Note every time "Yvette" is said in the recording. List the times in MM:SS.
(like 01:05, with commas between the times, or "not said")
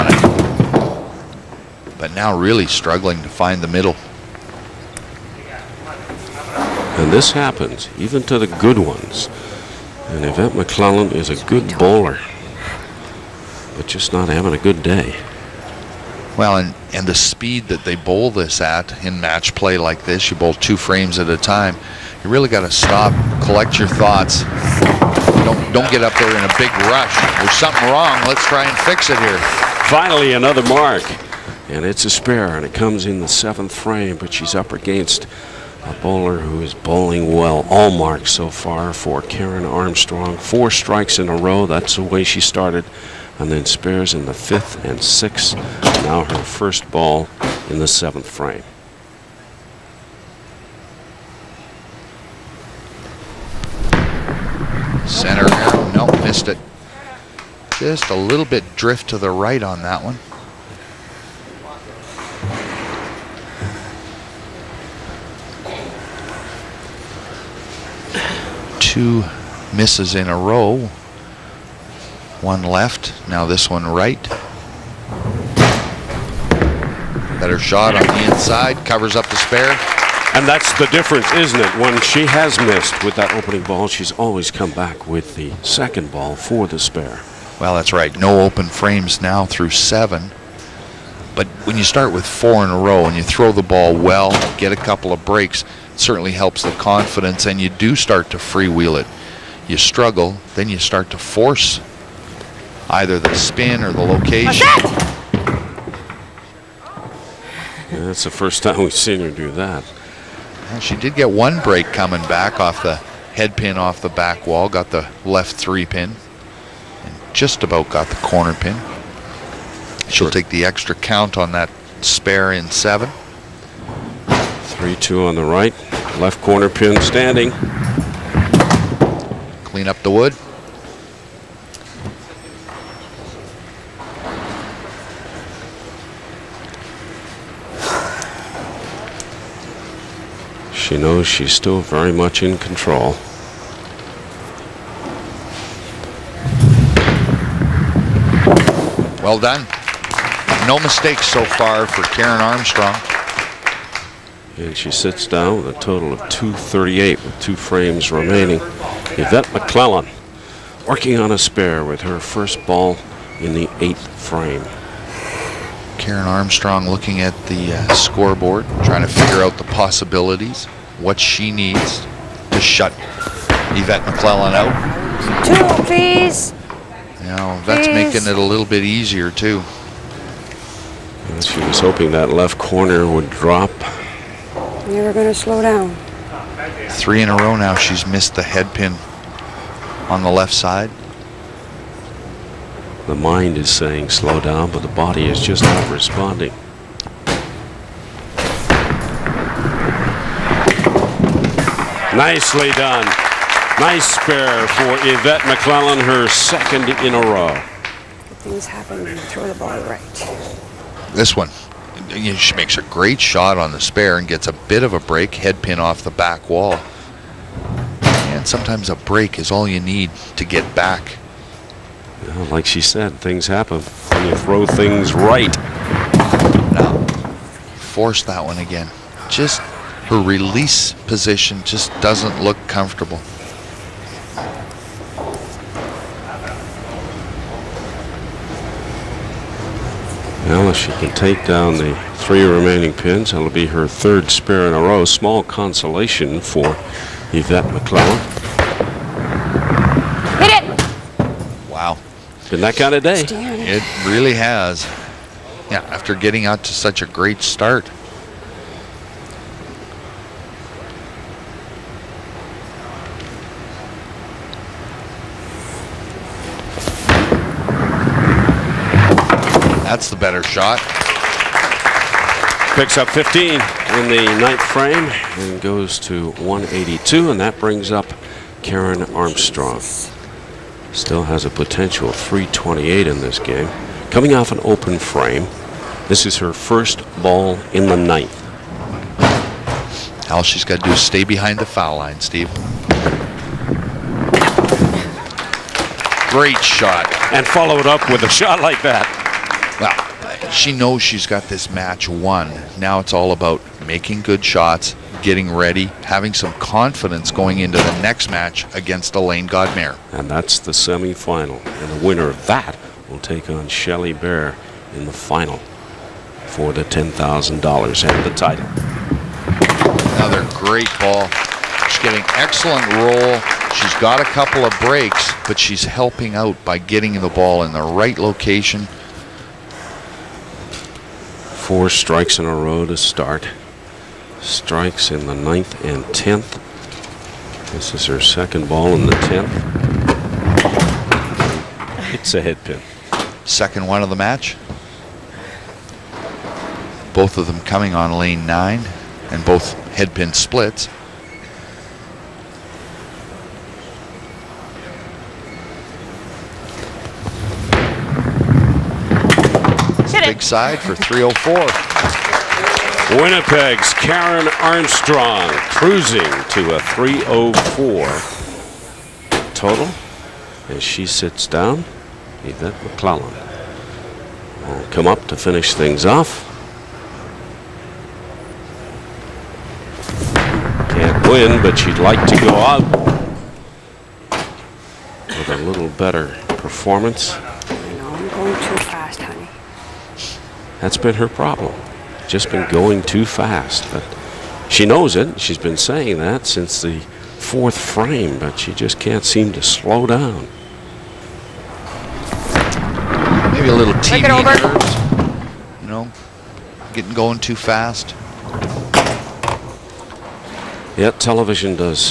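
00:10, 02:39, 02:53, 03:25, 04:07, 06:12.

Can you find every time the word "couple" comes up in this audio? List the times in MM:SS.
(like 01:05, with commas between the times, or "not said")
01:34, 05:24.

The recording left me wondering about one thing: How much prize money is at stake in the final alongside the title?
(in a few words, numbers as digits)
$10,000.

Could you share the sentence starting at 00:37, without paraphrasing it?
All marks so far for Karen Armstrong.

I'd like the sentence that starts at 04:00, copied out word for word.
she can take down the three remaining pins.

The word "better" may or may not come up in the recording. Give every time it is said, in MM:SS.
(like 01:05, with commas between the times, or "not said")
01:17, 04:30, 06:25.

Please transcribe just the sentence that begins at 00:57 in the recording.
Just a little bit drift to the right on that one.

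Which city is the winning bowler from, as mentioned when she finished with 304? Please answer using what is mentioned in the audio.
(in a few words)
Winnipeg.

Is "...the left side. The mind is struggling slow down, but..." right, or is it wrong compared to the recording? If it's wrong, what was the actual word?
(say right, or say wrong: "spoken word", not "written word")
wrong: "saying", not "struggling".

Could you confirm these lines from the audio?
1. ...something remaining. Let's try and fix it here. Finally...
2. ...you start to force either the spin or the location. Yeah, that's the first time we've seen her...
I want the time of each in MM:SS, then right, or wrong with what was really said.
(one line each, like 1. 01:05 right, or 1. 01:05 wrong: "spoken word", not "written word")
1. 00:27 wrong: "wrong", not "remaining"
2. 01:40 right.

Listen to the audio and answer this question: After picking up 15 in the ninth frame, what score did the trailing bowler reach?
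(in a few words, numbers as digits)
182.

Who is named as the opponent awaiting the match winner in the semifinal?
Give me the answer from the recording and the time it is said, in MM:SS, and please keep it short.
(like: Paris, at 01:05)
Elaine Godmere, at 05:09.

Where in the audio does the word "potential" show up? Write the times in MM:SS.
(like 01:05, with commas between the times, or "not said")
04:41.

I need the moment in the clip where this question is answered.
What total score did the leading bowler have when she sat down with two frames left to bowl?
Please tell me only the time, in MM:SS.
02:36.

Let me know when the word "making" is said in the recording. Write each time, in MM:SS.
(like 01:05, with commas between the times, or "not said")
02:58, 05:03.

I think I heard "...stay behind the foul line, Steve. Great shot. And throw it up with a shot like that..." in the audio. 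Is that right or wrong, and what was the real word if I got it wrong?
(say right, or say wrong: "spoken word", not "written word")
wrong: "follow", not "throw".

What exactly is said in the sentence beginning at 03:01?
And she was hoping that left corner would drop.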